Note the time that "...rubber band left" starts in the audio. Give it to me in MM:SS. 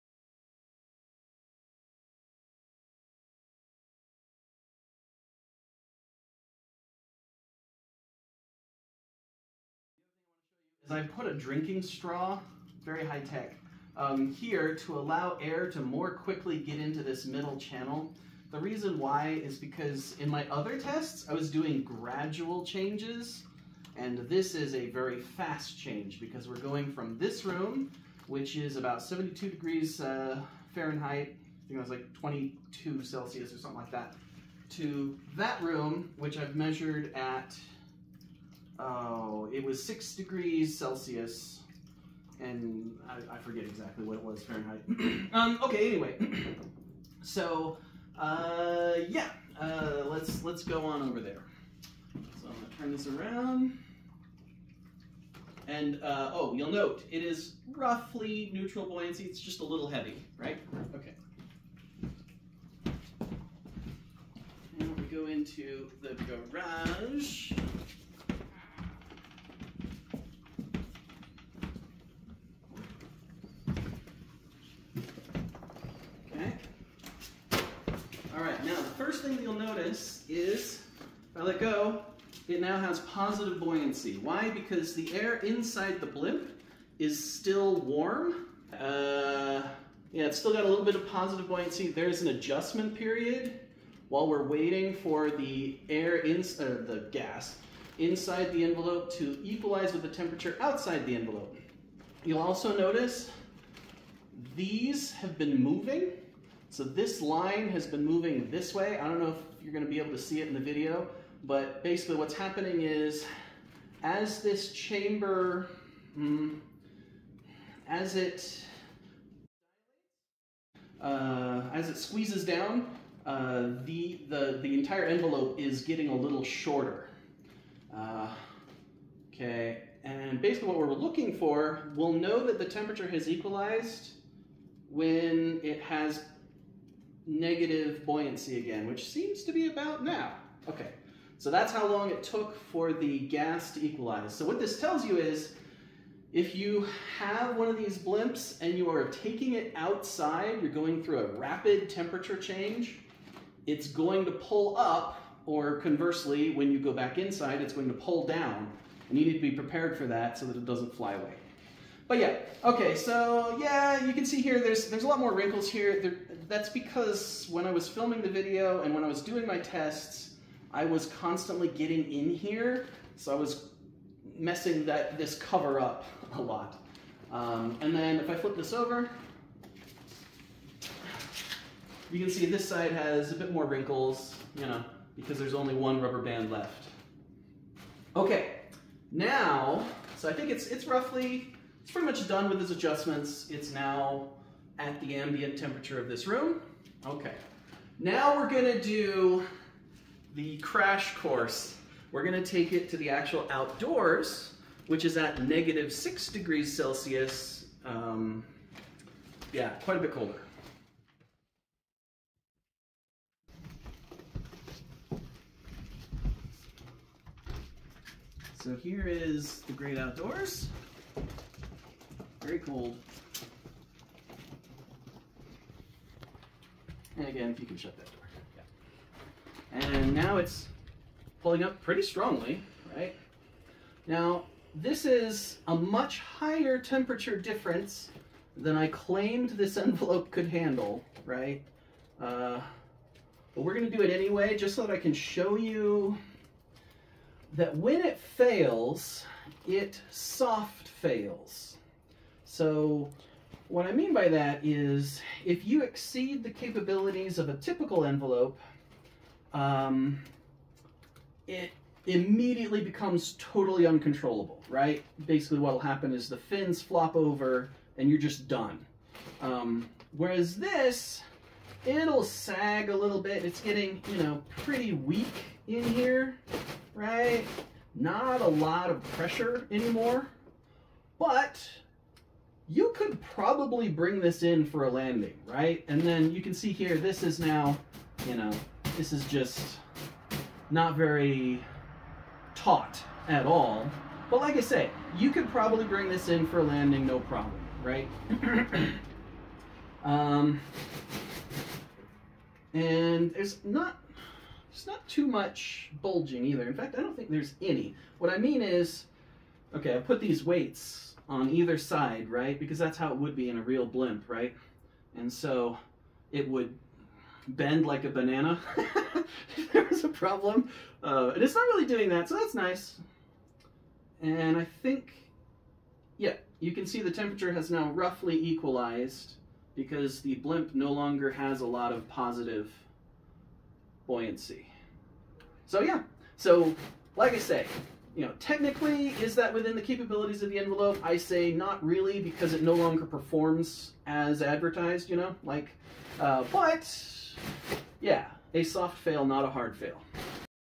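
03:06.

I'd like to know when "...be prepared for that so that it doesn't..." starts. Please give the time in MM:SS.
02:39.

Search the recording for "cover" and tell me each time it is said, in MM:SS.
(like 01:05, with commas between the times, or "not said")
02:55.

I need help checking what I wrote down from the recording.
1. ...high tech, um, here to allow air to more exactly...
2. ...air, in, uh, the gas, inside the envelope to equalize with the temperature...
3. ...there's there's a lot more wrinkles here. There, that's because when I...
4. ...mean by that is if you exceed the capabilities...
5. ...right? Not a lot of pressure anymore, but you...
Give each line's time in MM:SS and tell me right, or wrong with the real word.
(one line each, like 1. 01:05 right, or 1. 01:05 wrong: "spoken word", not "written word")
1. 00:13 wrong: "quickly", not "exactly"
2. 01:35 right
3. 02:44 right
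4. 04:13 right
5. 04:36 right.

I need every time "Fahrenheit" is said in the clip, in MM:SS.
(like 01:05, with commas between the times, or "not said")
00:30, 00:44.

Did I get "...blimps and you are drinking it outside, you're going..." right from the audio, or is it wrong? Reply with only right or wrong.
wrong.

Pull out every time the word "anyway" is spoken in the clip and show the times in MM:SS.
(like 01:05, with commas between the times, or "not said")
00:45, 04:04.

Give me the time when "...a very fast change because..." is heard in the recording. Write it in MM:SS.
00:24.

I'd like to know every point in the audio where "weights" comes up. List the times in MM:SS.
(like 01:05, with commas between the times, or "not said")
05:10.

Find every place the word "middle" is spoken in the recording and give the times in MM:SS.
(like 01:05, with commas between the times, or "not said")
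00:17.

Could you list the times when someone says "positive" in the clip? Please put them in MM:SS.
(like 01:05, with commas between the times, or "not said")
01:23, 01:31, 05:32.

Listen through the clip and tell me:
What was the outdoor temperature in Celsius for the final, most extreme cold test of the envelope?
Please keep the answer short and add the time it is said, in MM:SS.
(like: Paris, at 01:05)
-6 degrees Celsius, at 03:25.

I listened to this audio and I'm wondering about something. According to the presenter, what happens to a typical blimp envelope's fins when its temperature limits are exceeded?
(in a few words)
fins flop over.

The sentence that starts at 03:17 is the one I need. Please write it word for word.
Okay, now we're gonna do the crash course.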